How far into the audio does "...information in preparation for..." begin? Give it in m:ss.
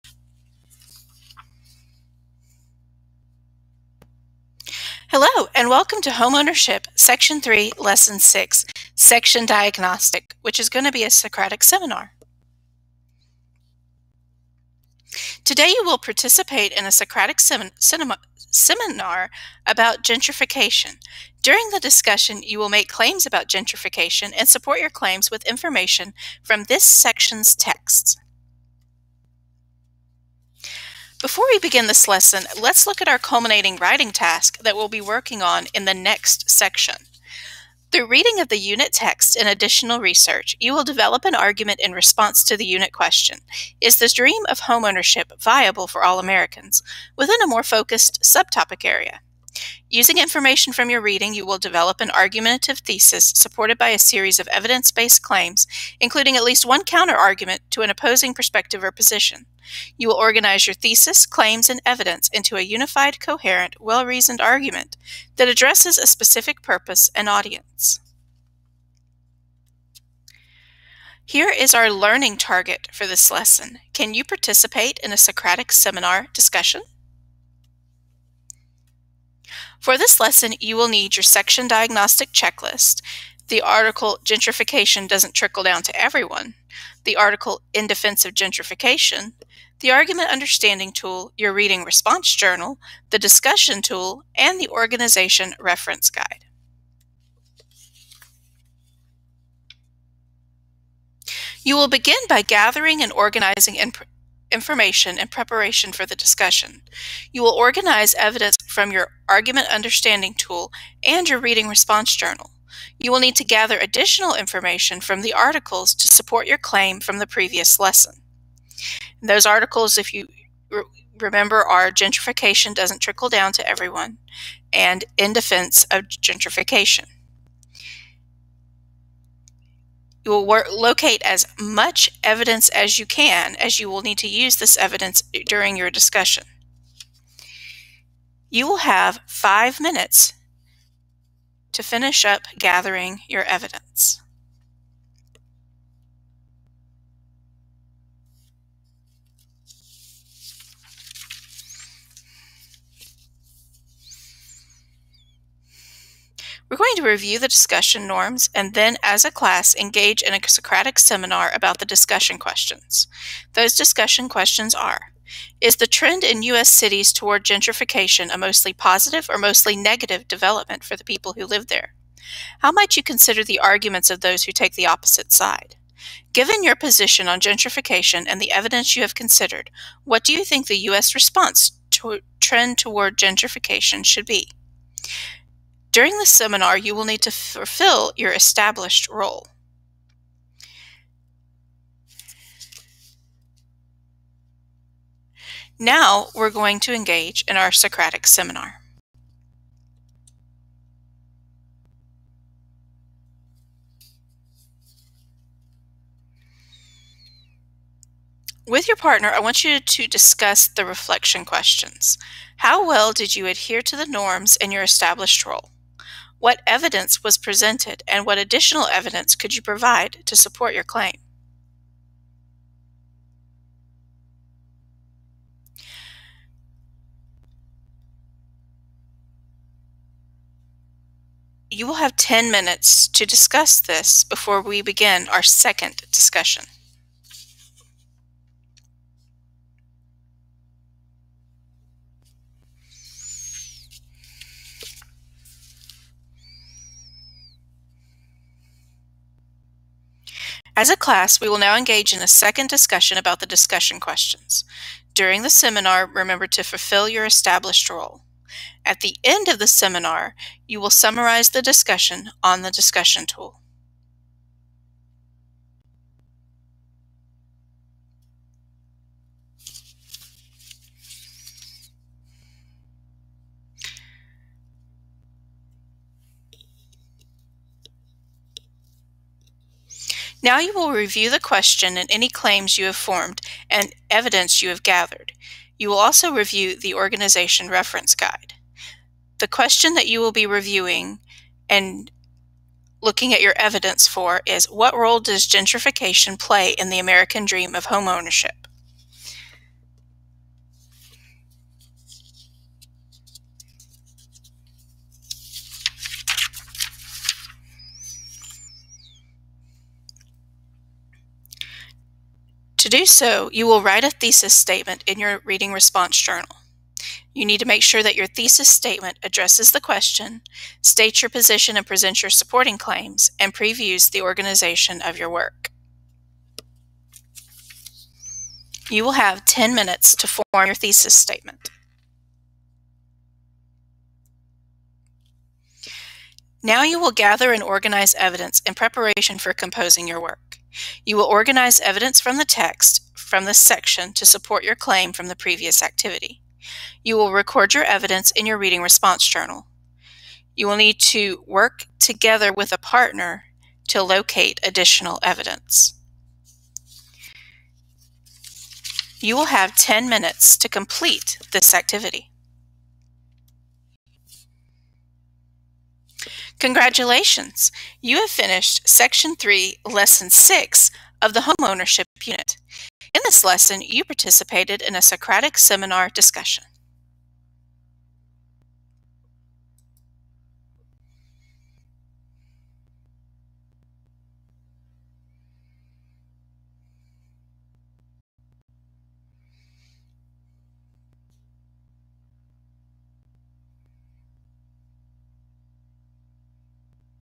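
1:44.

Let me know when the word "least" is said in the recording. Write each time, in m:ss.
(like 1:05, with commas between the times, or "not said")
0:56.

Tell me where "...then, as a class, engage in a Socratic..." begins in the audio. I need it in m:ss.
2:38.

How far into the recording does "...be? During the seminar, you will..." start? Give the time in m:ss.
3:04.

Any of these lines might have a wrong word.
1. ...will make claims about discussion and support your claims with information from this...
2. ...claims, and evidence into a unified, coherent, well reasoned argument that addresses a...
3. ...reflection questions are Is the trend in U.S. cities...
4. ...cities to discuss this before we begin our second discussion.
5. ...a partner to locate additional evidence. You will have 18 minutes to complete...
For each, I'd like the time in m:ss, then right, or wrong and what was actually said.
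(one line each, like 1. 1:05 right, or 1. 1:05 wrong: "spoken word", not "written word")
1. 0:22 wrong: "gentrification", not "discussion"
2. 1:01 right
3. 2:43 wrong: "discussion", not "reflection"
4. 3:52 wrong: "minutes", not "cities"
5. 5:52 wrong: "10", not "18".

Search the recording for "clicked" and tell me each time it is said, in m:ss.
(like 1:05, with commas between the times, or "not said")
not said.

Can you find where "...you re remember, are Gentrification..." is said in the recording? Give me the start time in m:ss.
2:00.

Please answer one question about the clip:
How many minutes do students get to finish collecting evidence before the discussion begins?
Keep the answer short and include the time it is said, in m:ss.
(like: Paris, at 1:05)
5, at 2:19.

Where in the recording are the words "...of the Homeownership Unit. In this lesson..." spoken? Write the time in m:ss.
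6:11.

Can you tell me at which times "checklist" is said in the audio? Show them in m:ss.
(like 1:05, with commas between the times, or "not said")
1:22.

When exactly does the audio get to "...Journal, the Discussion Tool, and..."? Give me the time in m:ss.
1:32.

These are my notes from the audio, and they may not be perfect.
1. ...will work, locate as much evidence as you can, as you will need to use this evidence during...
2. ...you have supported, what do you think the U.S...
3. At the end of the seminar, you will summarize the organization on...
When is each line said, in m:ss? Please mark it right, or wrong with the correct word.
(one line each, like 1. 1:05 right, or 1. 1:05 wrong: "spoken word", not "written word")
1. 2:10 right
2. 2:58 wrong: "considered", not "supported"
3. 4:18 wrong: "discussion", not "organization".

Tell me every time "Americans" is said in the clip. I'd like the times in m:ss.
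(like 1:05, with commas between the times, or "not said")
0:46, 4:56.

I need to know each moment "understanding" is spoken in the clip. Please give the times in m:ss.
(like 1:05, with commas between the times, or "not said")
1:30, 1:49.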